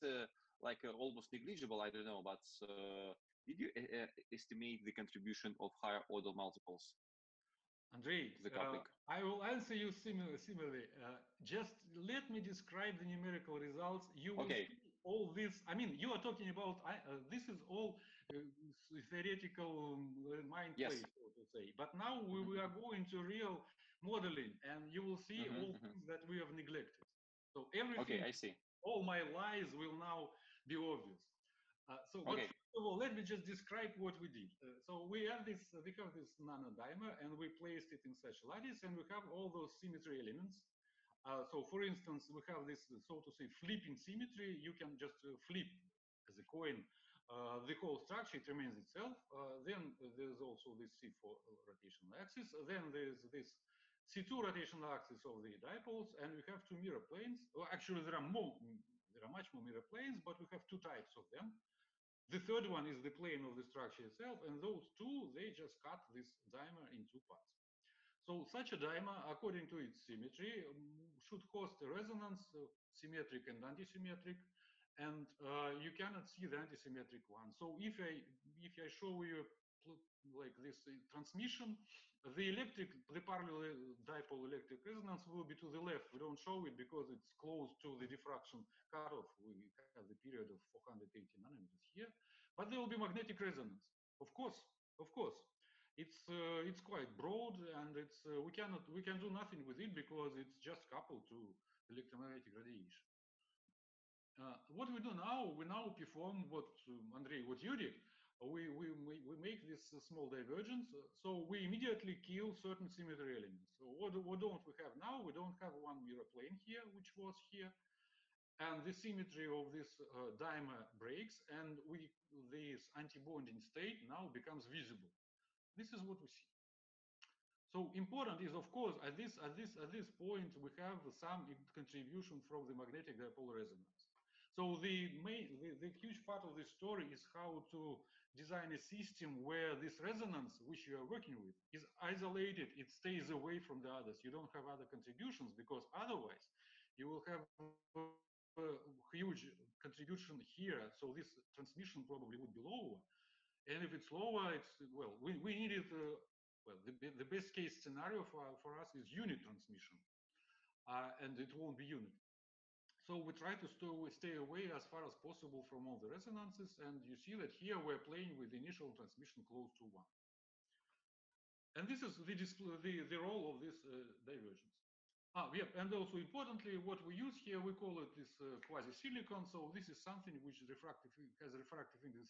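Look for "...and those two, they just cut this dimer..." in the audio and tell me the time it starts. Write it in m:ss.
1:04.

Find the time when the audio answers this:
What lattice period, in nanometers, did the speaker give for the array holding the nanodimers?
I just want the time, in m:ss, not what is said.
1:30.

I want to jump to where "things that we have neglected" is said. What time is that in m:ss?
0:25.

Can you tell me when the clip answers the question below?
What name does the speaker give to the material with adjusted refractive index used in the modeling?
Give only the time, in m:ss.
2:58.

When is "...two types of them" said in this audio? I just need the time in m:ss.
1:00.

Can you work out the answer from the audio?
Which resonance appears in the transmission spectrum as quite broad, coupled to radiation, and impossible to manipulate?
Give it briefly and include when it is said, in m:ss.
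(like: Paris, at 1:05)
magnetic resonance, at 1:32.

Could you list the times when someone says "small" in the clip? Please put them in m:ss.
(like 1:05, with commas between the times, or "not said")
1:49.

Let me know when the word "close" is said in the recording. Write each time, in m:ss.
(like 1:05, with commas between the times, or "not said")
1:27, 2:49.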